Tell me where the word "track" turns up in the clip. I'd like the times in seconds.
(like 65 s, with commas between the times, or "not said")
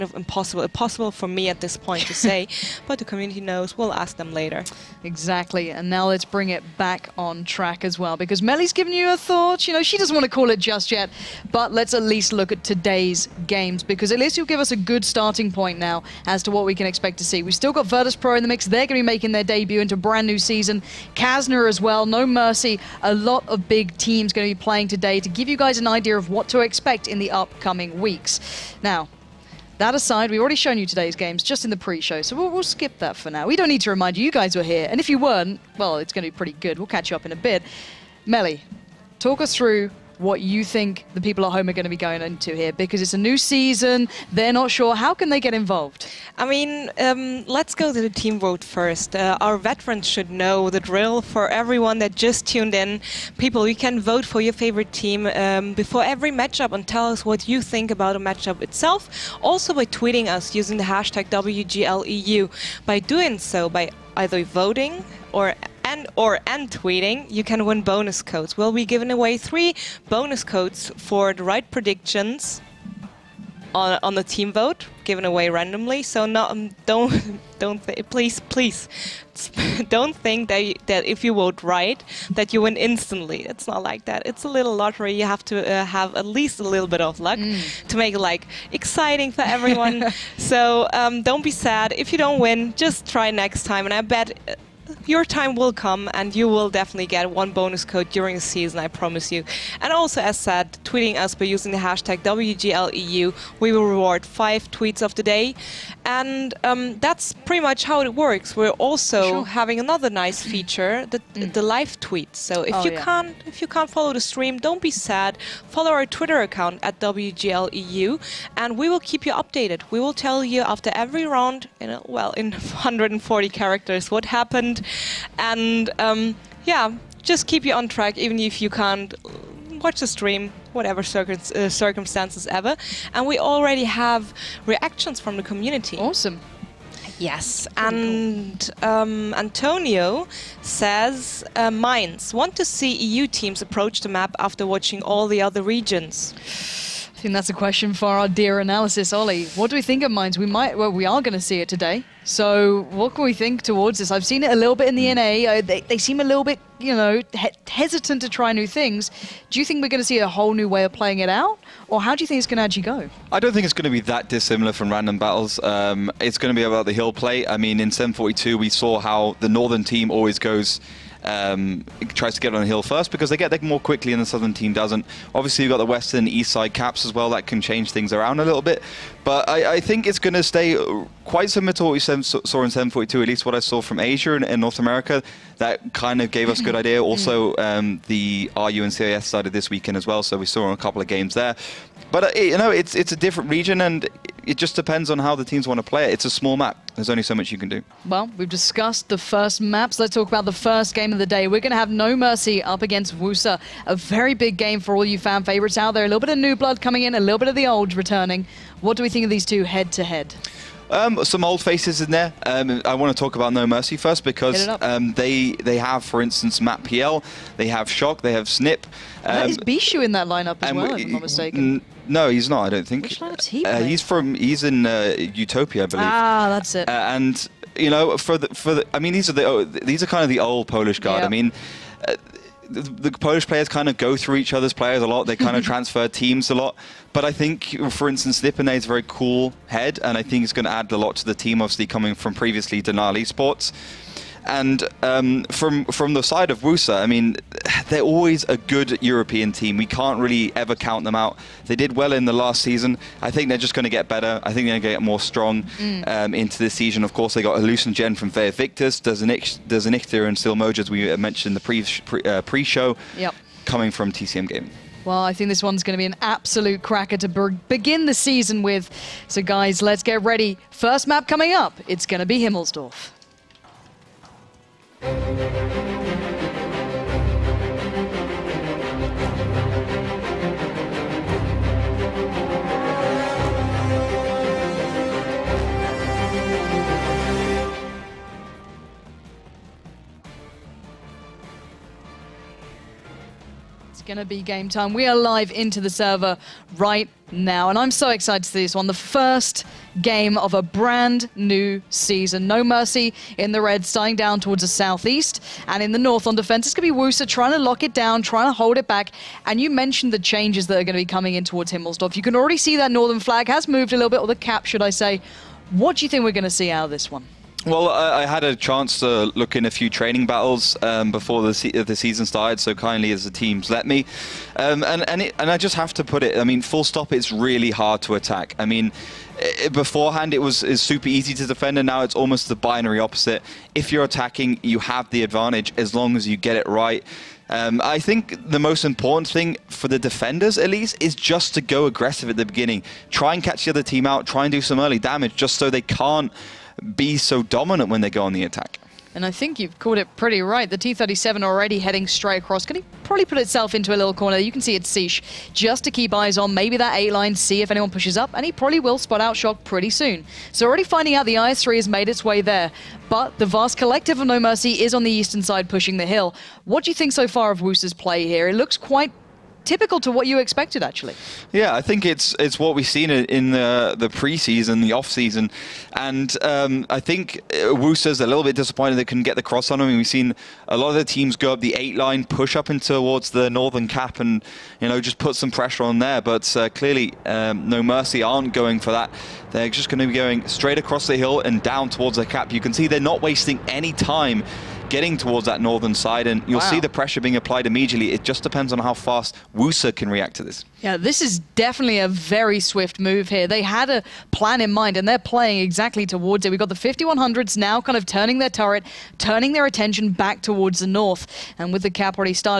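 7 s, 127 s.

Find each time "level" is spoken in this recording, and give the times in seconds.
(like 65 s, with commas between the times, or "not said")
not said.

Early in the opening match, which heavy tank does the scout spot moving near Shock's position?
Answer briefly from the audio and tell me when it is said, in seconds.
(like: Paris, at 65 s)
IS-3, at 361 s.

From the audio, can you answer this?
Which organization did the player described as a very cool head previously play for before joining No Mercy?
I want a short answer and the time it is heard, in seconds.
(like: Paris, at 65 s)
Denali Sports, at 242 s.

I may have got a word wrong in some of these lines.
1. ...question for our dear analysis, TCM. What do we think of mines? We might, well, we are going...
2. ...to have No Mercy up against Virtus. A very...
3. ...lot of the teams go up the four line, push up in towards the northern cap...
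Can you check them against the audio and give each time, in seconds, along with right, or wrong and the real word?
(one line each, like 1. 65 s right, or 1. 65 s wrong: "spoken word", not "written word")
1. 147 s wrong: "Ollie", not "TCM"
2. 201 s wrong: "Wusa", not "Virtus"
3. 380 s wrong: "eight", not "four".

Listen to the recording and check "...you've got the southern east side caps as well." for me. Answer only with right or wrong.
wrong.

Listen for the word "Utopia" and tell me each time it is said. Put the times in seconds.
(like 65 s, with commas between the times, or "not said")
225 s.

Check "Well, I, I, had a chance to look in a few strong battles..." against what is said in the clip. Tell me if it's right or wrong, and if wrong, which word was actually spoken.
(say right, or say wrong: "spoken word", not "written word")
wrong: "training", not "strong".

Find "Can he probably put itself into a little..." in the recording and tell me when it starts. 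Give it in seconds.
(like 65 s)
352 s.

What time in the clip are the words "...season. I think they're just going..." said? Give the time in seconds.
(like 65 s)
252 s.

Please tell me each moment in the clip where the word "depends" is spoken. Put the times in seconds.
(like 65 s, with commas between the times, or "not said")
194 s, 398 s.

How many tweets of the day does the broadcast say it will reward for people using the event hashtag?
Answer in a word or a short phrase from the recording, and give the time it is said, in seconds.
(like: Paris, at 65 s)
5, at 104 s.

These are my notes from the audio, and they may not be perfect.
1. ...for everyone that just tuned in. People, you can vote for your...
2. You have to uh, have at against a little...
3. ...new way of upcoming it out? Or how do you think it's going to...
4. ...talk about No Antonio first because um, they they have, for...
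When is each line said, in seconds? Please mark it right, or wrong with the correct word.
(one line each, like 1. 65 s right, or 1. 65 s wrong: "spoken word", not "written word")
1. 51 s right
2. 85 s wrong: "least", not "against"
3. 160 s wrong: "playing", not "upcoming"
4. 213 s wrong: "Mercy", not "Antonio".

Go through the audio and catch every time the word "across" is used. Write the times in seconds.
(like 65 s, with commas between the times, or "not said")
352 s, 390 s.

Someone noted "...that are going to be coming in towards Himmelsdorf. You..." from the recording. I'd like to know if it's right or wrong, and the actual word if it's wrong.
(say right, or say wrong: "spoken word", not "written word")
right.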